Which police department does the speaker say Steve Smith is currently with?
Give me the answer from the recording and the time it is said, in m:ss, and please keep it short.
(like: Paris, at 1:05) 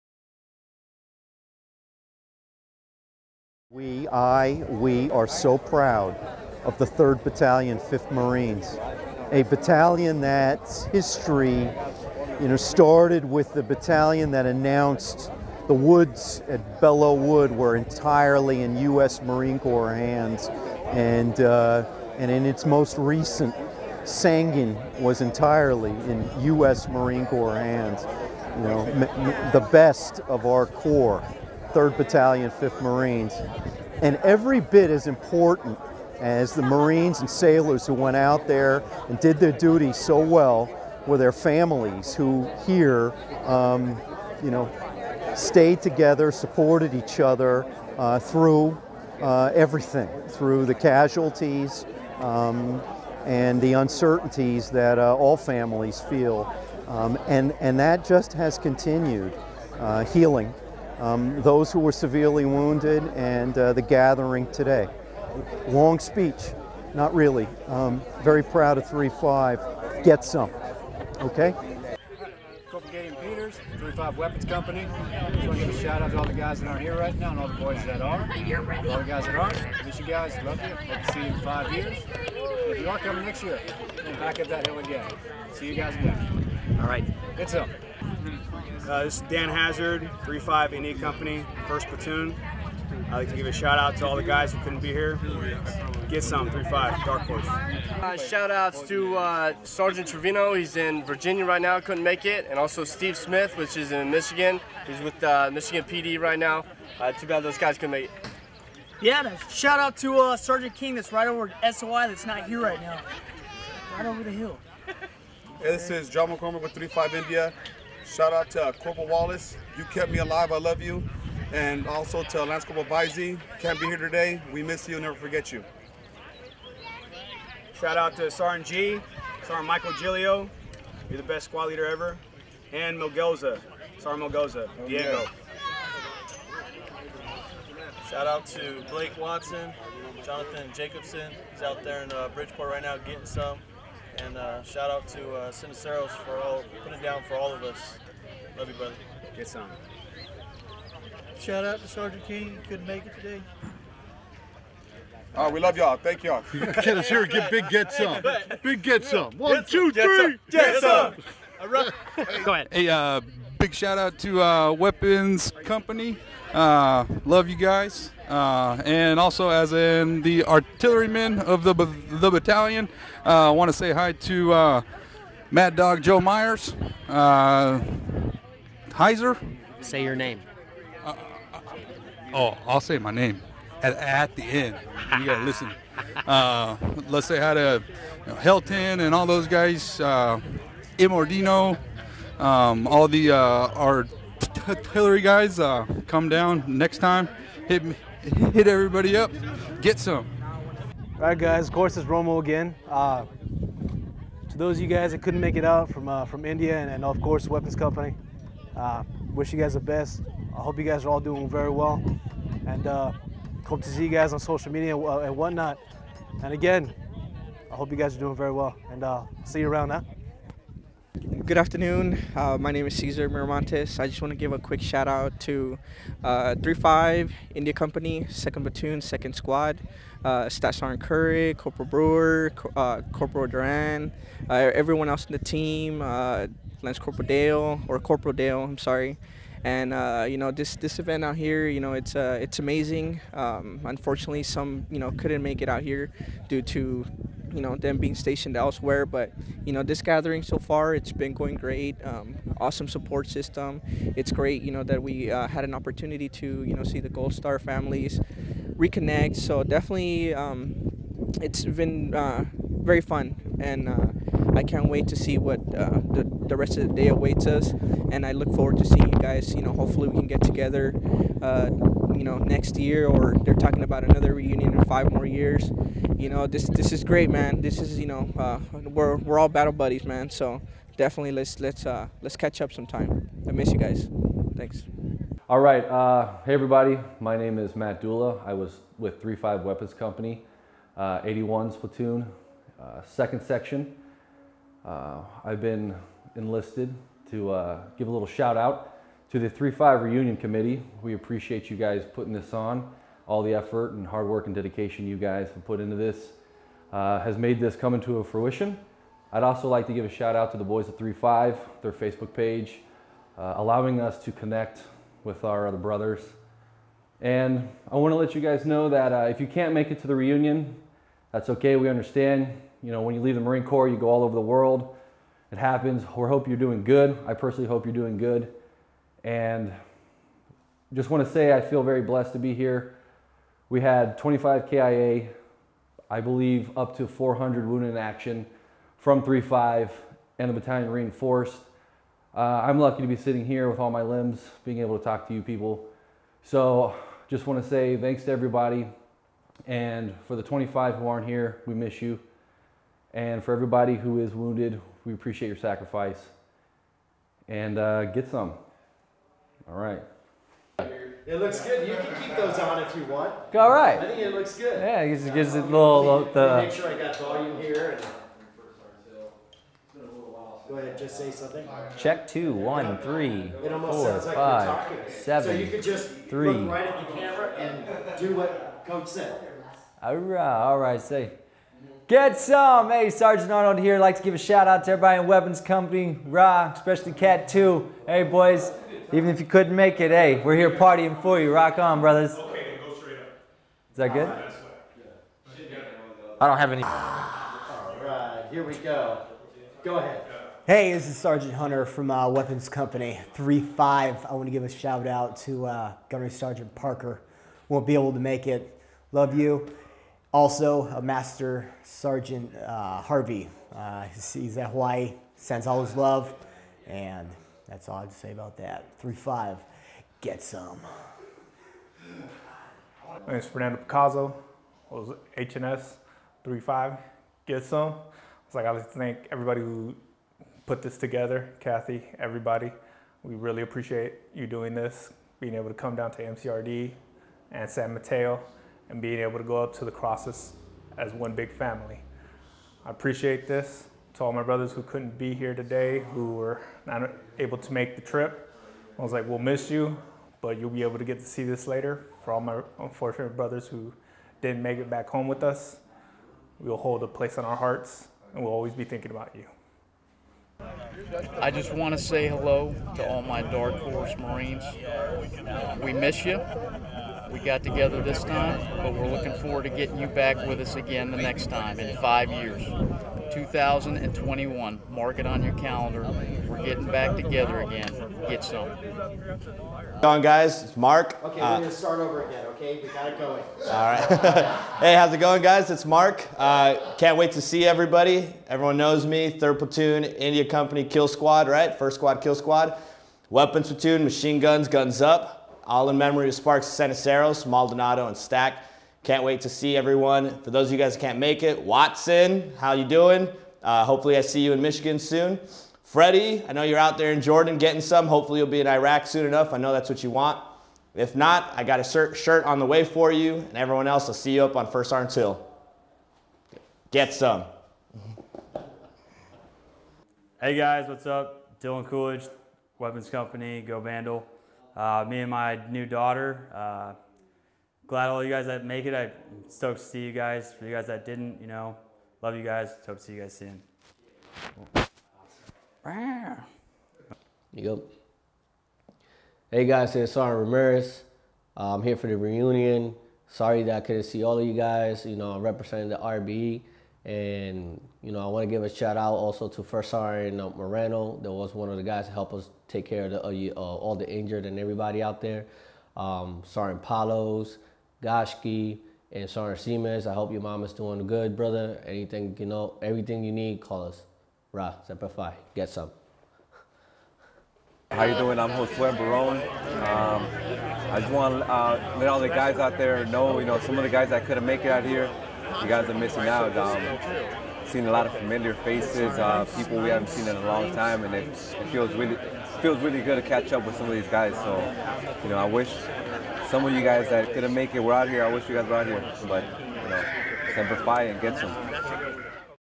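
Michigan PD, at 1:45.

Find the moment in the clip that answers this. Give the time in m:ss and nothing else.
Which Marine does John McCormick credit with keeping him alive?
1:58.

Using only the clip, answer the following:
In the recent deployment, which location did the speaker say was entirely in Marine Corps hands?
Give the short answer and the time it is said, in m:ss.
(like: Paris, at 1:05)
Sangin, at 0:24.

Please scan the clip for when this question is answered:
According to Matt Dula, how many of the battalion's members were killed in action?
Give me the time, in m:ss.
5:34.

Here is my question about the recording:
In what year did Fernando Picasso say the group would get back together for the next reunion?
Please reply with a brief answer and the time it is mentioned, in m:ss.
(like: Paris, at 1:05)
2021, at 7:53.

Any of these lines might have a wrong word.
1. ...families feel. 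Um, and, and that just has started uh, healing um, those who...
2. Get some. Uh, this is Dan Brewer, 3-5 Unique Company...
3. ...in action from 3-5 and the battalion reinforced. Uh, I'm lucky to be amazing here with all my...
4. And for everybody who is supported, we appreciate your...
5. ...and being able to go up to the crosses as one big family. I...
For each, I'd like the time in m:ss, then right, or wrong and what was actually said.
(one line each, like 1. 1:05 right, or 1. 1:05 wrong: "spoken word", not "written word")
1. 0:55 wrong: "continued", not "started"
2. 1:27 wrong: "Hazard", not "Brewer"
3. 5:37 wrong: "sitting", not "amazing"
4. 5:53 wrong: "wounded", not "supported"
5. 7:18 right.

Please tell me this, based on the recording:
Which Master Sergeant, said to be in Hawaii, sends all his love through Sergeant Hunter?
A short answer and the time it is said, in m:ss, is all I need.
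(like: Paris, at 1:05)
Harvey, at 6:53.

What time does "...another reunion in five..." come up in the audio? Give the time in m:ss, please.
4:34.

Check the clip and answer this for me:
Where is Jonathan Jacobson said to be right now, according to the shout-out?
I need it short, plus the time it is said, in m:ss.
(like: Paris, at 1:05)
Bridgeport, at 2:22.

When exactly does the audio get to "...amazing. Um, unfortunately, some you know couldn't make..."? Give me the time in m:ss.
4:02.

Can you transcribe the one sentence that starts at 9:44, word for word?
So, you know, I wish some of you guys that couldn't make it were out here.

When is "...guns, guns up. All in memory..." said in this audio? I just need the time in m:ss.
8:14.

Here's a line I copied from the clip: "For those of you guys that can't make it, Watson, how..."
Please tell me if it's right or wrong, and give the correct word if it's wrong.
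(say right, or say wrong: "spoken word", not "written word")
right.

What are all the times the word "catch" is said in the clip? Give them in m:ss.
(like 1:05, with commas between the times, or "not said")
4:42, 9:43.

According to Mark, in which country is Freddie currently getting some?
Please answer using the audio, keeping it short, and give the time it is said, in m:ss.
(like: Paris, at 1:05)
Jordan, at 8:27.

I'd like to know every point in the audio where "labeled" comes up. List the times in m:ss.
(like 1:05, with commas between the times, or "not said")
not said.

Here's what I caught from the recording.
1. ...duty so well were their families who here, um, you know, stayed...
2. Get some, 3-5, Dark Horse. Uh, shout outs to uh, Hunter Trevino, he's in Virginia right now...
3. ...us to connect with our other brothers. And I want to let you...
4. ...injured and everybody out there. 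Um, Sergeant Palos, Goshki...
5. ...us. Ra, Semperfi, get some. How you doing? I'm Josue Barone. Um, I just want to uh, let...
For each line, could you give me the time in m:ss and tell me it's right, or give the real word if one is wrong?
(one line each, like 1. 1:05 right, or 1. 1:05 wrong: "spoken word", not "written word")
1. 0:39 right
2. 1:36 wrong: "Sergeant", not "Hunter"
3. 5:14 right
4. 9:14 right
5. 9:23 right.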